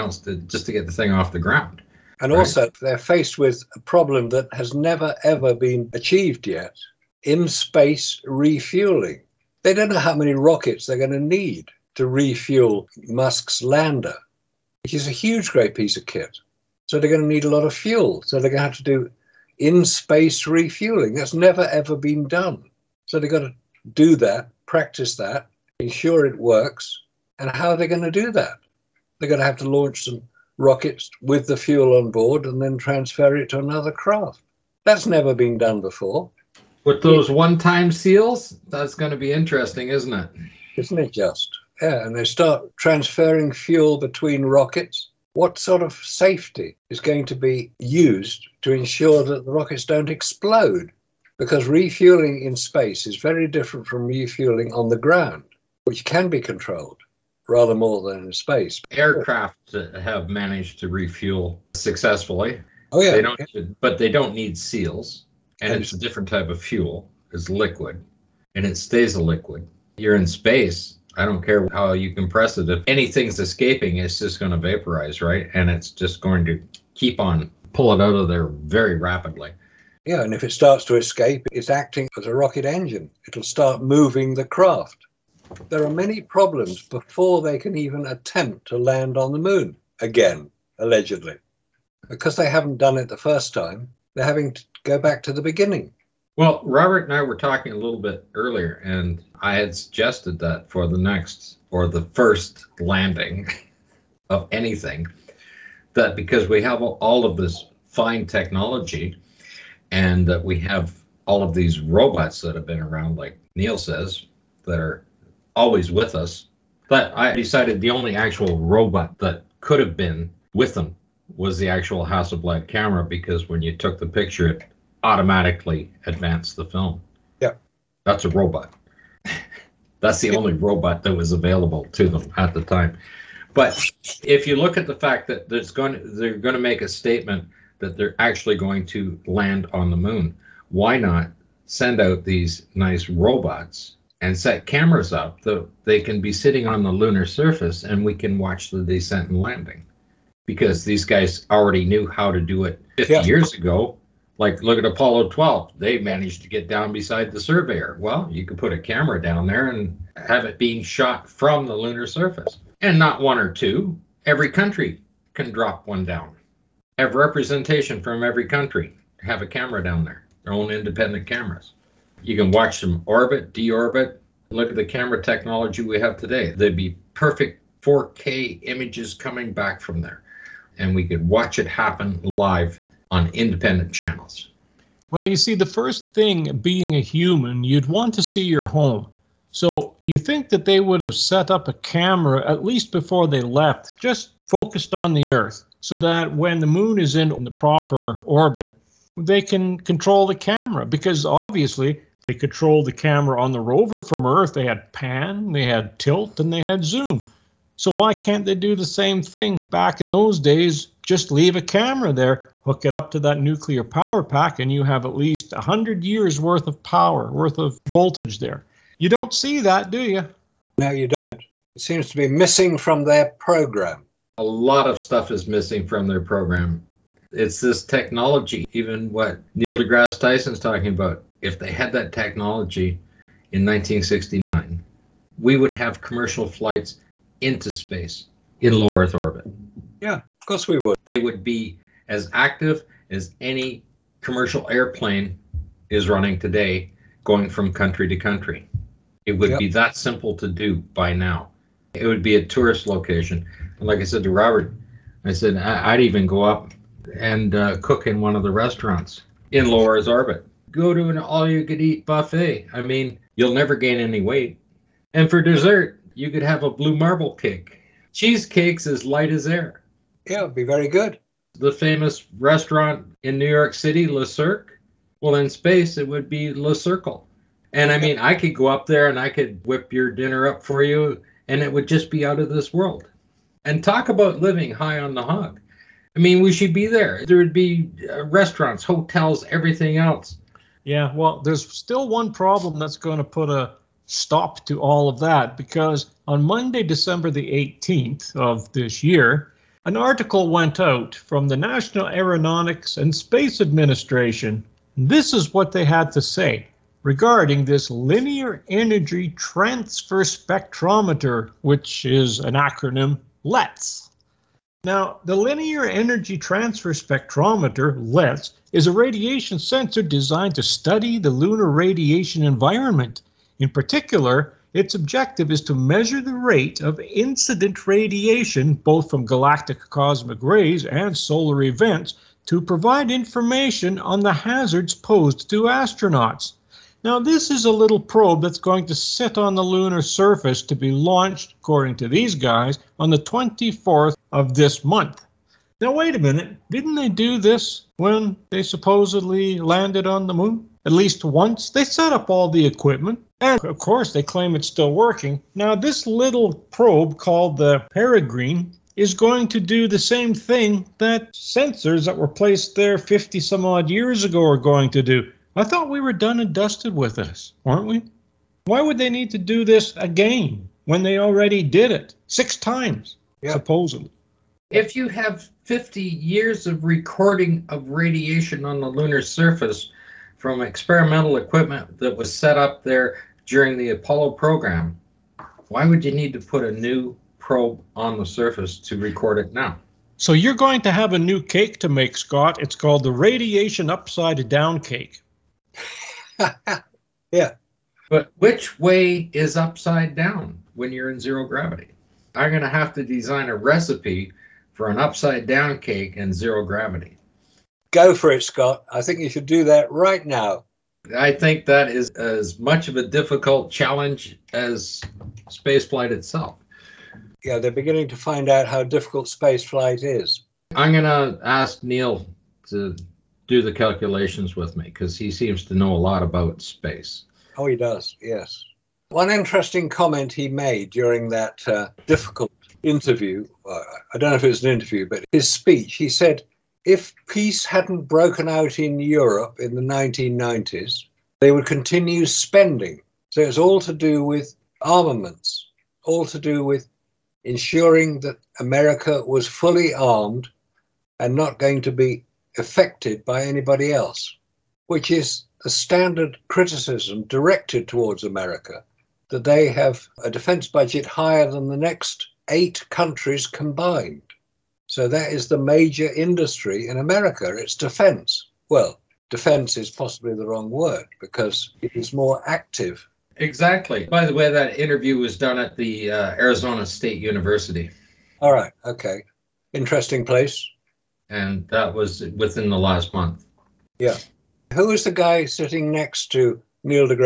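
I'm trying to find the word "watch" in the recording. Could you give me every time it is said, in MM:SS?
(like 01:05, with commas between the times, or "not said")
02:28, 02:52, 03:01.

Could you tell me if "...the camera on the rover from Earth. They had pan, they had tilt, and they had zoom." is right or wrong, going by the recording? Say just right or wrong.
right.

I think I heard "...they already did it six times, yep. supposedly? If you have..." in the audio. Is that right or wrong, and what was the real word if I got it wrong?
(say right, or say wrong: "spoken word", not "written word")
right.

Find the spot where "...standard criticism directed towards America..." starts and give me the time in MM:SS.
07:35.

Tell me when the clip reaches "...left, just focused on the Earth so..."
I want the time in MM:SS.
03:13.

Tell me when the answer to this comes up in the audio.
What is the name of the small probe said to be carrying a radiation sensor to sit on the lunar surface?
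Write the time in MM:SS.
05:57.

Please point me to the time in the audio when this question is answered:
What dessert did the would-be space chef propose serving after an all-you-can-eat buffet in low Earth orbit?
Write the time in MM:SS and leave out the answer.
04:26.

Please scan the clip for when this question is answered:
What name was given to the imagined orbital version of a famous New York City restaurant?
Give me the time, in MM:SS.
04:36.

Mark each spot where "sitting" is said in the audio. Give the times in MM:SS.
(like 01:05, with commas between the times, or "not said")
02:26, 08:05.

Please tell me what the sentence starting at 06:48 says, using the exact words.
I think you should do that right now.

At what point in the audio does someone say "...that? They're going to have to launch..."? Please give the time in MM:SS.
00:28.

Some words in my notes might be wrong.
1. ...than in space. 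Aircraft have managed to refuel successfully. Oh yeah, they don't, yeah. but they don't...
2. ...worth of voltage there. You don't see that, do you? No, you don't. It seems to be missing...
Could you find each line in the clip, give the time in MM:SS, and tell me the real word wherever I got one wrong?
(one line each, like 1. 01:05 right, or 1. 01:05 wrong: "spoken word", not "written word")
1. 00:58 right
2. 03:37 right.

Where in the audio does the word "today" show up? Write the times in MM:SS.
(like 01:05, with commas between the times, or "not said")
02:56, 04:06.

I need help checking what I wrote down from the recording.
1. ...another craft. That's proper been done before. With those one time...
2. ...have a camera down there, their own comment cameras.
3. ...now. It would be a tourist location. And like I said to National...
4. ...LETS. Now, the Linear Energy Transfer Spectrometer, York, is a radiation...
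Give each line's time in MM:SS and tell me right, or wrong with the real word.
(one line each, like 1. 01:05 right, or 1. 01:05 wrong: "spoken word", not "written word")
1. 00:33 wrong: "never", not "proper"
2. 02:49 wrong: "independent", not "comment"
3. 04:11 wrong: "Robert", not "National"
4. 05:13 wrong: "LETS", not "York".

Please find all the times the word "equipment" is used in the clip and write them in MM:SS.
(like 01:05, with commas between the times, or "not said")
05:52, 06:21.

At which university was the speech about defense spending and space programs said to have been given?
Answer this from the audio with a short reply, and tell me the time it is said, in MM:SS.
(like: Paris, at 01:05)
Arizona State University, at 07:56.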